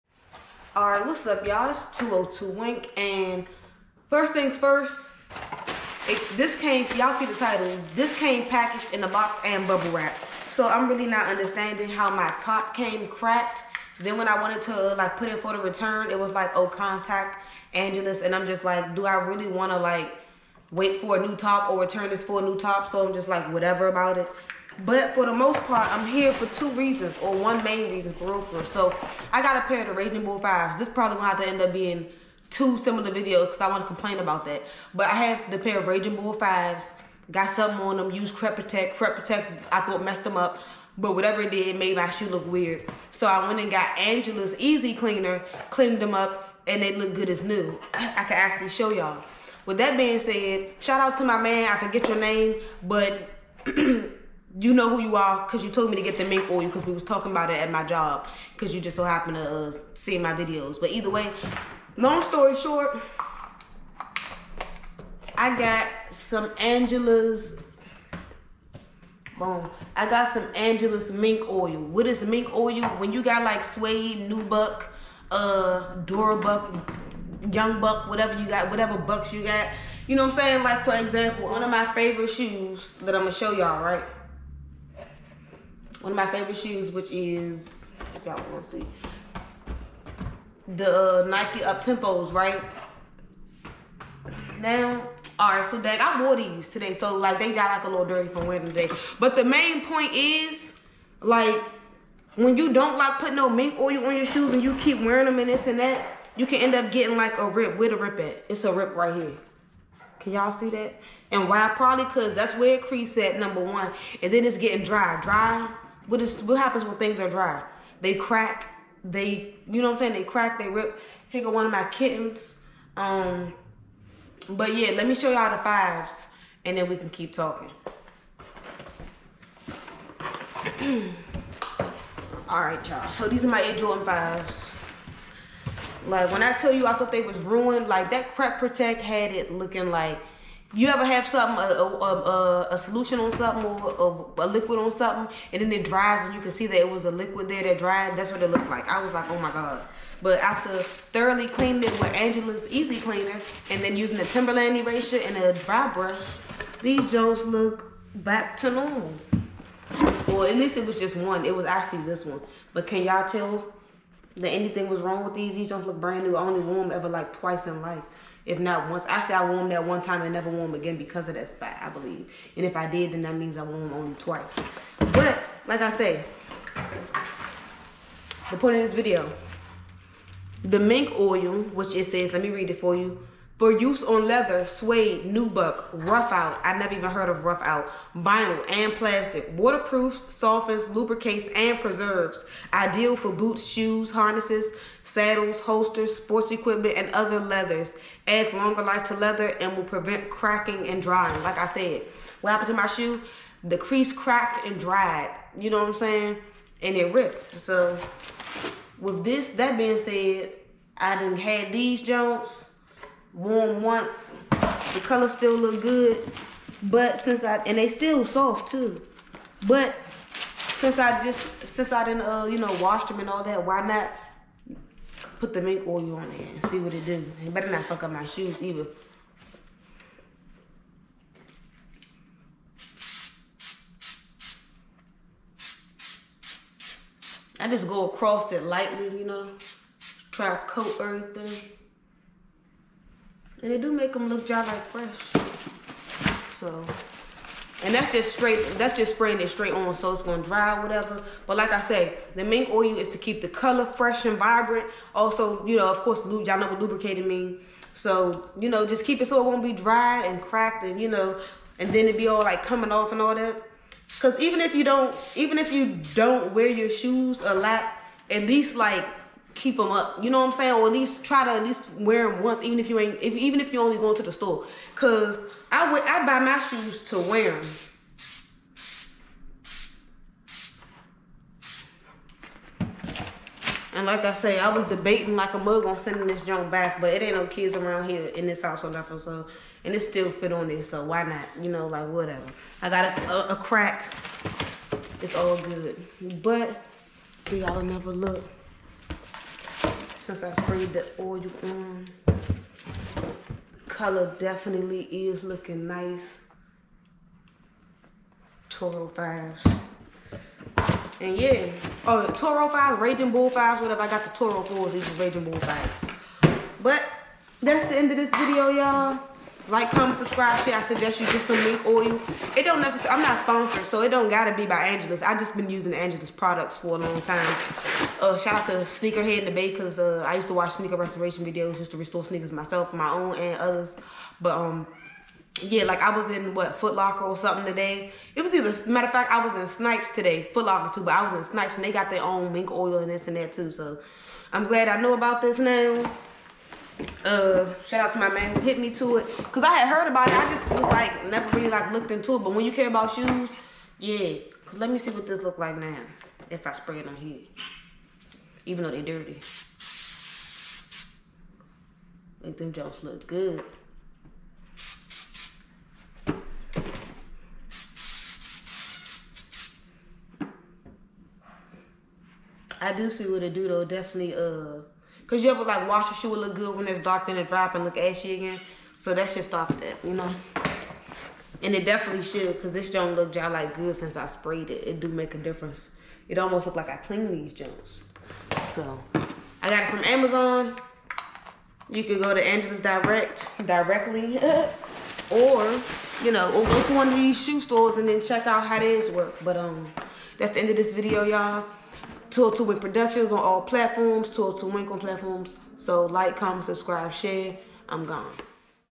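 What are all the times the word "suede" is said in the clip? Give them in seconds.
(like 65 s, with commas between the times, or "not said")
73 s, 184 s.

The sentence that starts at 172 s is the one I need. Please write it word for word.
And if I did, then that means I wore them only twice.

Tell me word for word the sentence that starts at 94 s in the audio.
Now, all right, so Dag, I wore these today, so like they got like a little dirty from wearing today.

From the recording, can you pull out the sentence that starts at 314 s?
I got the Toro 4s, these are Raging Bull 5s.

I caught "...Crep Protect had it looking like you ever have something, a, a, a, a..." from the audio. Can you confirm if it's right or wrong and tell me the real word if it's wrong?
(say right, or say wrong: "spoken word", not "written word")
right.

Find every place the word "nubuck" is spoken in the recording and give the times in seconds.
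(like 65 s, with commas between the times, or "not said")
74 s, 185 s.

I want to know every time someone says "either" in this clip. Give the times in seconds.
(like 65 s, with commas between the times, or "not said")
60 s, 228 s, 338 s.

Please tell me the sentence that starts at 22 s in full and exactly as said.
So I'm just like, whatever about it.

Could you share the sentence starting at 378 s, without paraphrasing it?
So that should stop that, you know?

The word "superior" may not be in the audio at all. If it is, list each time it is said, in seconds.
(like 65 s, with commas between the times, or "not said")
not said.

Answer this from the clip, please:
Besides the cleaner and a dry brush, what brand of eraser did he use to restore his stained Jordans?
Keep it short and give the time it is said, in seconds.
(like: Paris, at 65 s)
Timberland, at 154 s.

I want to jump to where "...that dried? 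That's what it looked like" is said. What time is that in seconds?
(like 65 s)
147 s.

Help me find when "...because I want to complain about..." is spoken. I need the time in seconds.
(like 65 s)
33 s.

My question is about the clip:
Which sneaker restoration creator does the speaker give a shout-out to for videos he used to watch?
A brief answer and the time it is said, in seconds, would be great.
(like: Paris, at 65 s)
Sneakerhead in the Bay, at 328 s.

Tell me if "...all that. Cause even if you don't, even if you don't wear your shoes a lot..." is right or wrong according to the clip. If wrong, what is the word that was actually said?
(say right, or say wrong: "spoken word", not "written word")
right.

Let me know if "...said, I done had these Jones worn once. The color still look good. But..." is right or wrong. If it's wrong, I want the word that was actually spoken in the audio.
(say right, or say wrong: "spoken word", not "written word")
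right.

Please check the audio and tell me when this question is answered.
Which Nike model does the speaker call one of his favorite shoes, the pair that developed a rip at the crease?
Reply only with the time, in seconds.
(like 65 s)
91 s.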